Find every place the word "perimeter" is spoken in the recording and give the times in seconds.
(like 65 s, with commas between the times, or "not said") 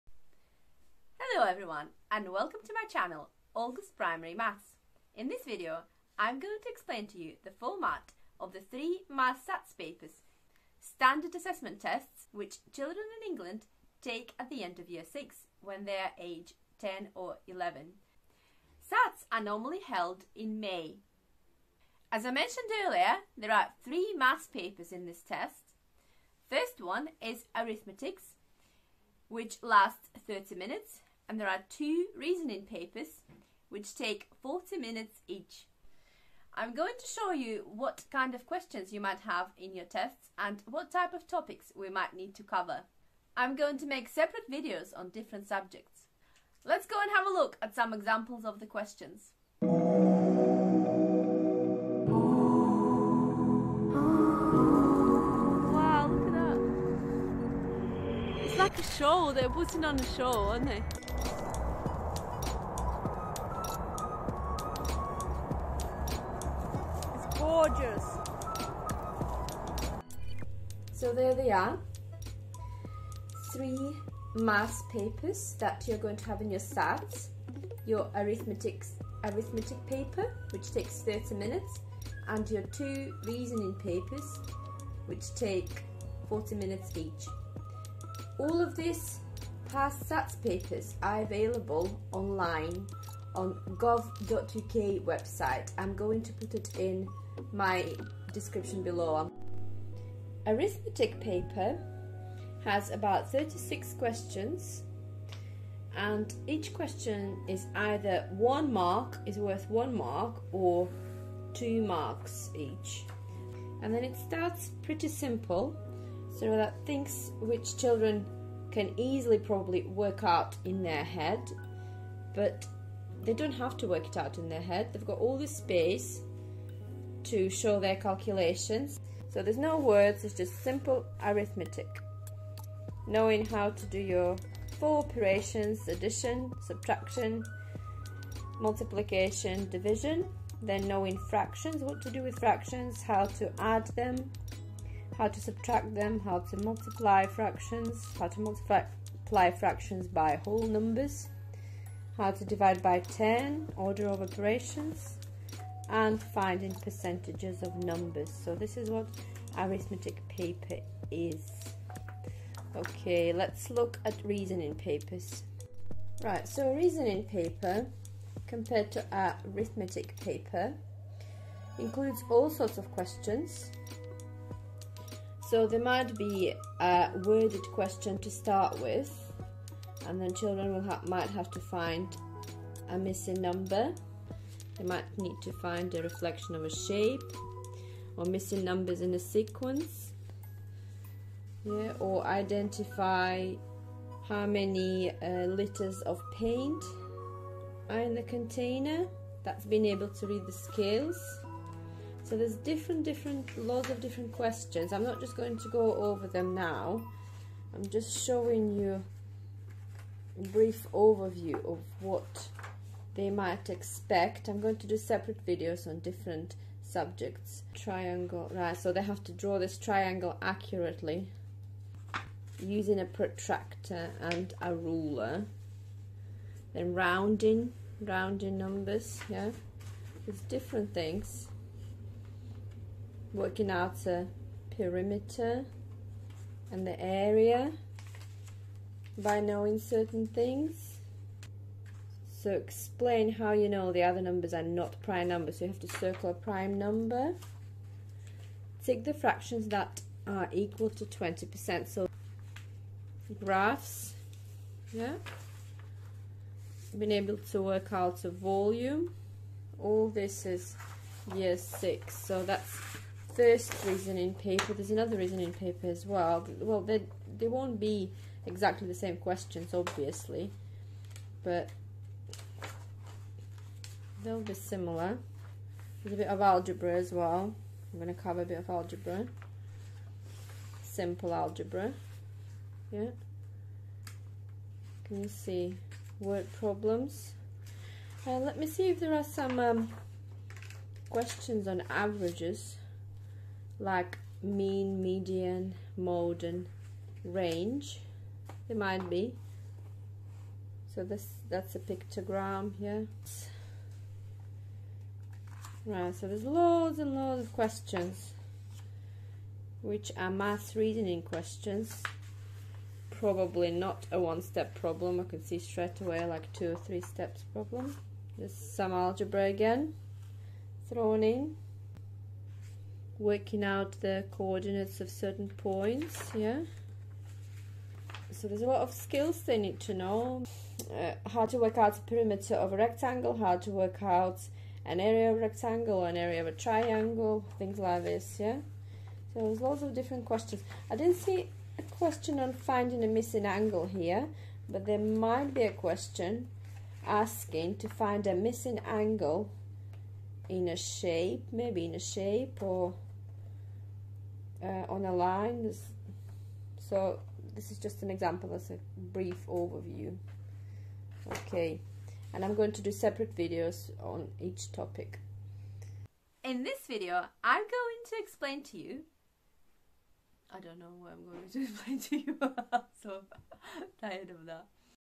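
234 s, 332 s.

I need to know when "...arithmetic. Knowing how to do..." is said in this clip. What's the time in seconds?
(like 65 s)
131 s.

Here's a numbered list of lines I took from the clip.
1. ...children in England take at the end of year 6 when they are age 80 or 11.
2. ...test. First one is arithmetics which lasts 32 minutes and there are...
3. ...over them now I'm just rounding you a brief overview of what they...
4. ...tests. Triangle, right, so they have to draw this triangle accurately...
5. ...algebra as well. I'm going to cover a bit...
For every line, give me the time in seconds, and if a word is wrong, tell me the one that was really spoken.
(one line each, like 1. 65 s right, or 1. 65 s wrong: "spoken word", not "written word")
1. 12 s wrong: "10", not "80"
2. 25 s wrong: "30", not "32"
3. 205 s wrong: "showing", not "rounding"
4. 216 s wrong: "subjects", not "tests"
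5. 276 s right.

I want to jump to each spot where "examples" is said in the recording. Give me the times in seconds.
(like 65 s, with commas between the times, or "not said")
47 s, 358 s.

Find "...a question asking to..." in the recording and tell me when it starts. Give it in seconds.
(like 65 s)
345 s.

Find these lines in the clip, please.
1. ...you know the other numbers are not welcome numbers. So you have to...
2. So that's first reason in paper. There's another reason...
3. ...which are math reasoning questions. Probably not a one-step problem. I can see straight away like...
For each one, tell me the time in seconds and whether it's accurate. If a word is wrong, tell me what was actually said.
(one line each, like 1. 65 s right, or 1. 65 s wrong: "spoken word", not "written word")
1. 243 s wrong: "prime", not "welcome"
2. 262 s right
3. 309 s right.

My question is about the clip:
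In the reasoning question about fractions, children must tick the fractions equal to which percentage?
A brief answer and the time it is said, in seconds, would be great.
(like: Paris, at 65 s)
20%, at 251 s.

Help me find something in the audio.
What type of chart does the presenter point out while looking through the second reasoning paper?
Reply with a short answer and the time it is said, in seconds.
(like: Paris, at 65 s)
Pictogram, at 301 s.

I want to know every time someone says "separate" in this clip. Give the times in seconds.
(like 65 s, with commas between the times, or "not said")
44 s, 214 s, 362 s.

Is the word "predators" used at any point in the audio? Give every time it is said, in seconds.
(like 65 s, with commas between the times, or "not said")
not said.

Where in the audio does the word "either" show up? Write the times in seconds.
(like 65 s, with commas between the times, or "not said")
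107 s.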